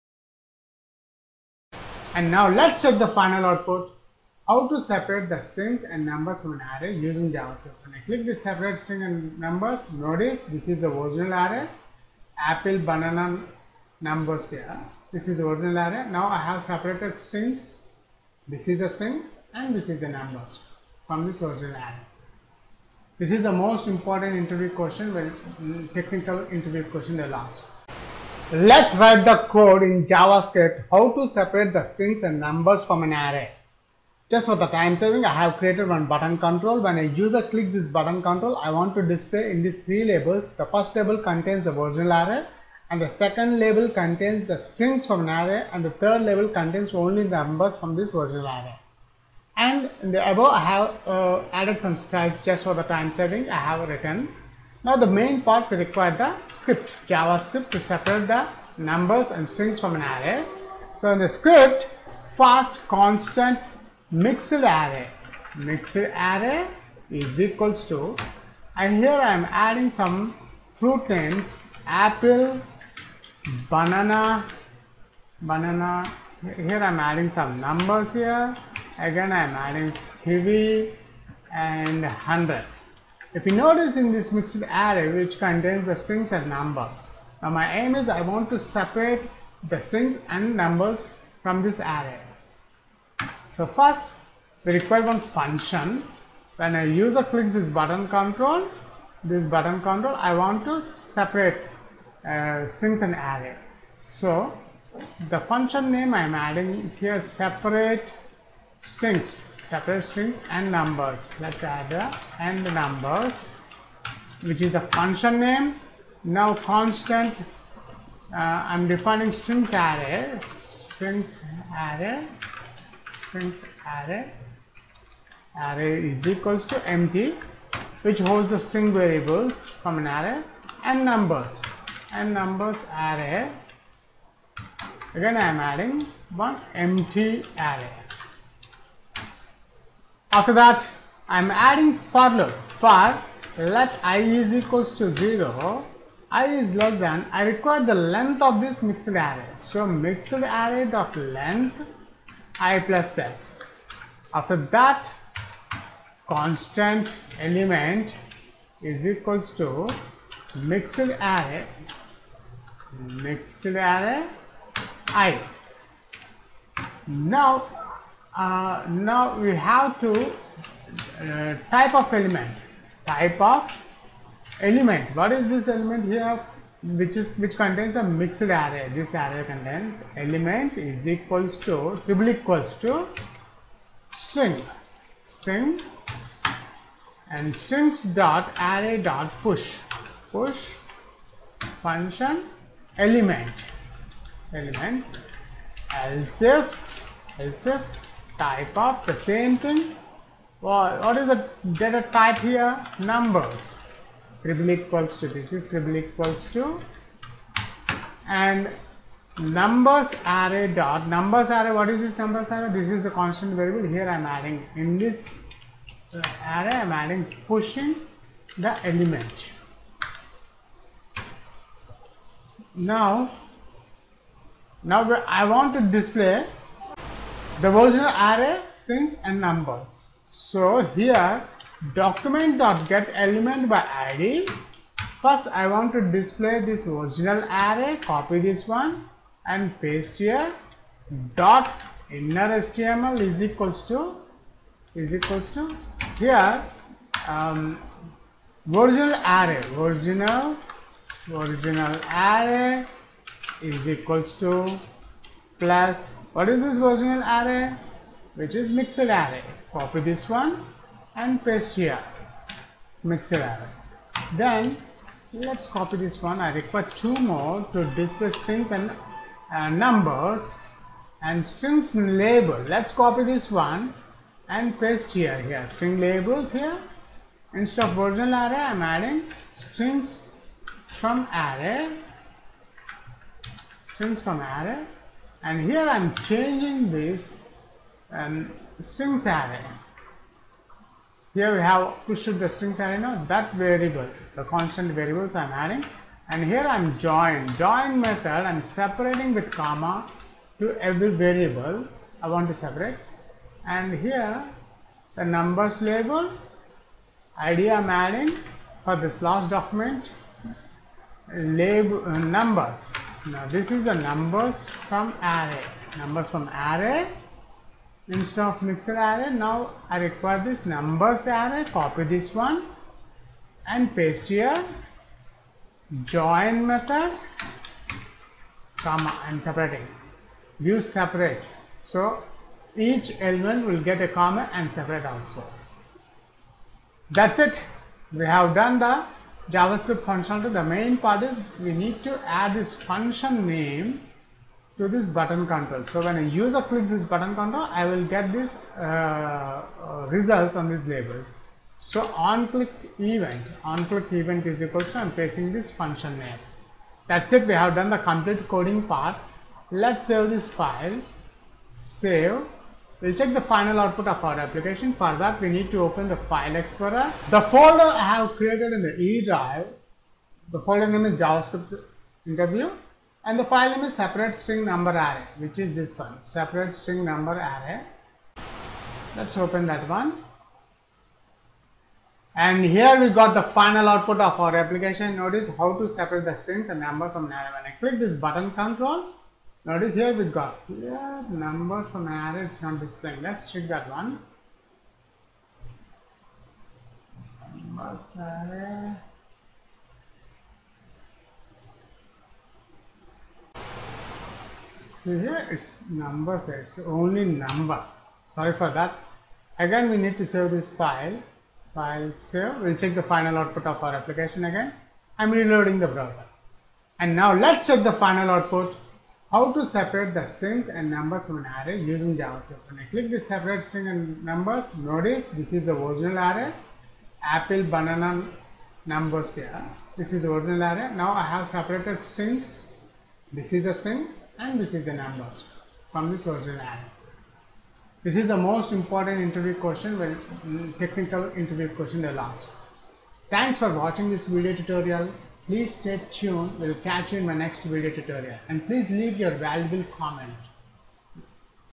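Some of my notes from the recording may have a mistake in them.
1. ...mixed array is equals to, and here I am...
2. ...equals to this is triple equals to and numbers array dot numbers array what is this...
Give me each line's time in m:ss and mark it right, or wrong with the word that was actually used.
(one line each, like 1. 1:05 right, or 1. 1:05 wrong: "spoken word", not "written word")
1. 1:05 right
2. 3:24 right.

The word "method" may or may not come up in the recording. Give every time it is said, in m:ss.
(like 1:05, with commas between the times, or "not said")
4:58, 5:26.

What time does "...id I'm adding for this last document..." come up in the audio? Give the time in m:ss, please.
5:07.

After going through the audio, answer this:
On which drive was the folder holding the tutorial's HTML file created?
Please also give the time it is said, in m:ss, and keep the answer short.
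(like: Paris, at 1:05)
E drive, at 6:08.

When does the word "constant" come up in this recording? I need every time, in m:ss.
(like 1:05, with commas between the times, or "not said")
1:02, 1:56, 2:36, 3:33, 4:54.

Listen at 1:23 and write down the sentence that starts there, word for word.
If you notice in this mixed array which contains the strings and numbers.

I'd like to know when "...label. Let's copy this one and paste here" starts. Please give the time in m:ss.
4:31.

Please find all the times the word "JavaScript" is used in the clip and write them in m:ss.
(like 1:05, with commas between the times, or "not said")
0:07, 0:30, 0:57, 5:39, 6:11, 7:02.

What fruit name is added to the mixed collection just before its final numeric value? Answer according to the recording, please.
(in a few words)
kiwi.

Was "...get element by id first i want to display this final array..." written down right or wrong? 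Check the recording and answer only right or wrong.
wrong.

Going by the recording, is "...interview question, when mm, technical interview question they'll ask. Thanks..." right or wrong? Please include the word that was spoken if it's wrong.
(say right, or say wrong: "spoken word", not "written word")
right.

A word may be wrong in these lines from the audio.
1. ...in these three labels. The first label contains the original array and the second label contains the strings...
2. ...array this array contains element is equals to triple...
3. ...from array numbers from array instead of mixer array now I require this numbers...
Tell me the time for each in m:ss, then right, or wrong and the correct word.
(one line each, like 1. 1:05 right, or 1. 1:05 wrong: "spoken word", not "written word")
1. 0:39 right
2. 2:58 right
3. 5:14 right.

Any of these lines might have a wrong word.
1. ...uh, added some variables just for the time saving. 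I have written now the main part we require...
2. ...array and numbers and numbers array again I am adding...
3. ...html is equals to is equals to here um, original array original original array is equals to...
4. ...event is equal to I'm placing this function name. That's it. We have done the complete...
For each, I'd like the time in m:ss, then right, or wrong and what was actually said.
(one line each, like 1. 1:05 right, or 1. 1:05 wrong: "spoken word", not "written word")
1. 0:51 wrong: "styles", not "variables"
2. 2:10 right
3. 4:02 right
4. 5:54 right.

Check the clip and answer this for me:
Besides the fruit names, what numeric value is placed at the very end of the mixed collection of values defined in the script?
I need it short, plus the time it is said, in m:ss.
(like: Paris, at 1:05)
100, at 1:20.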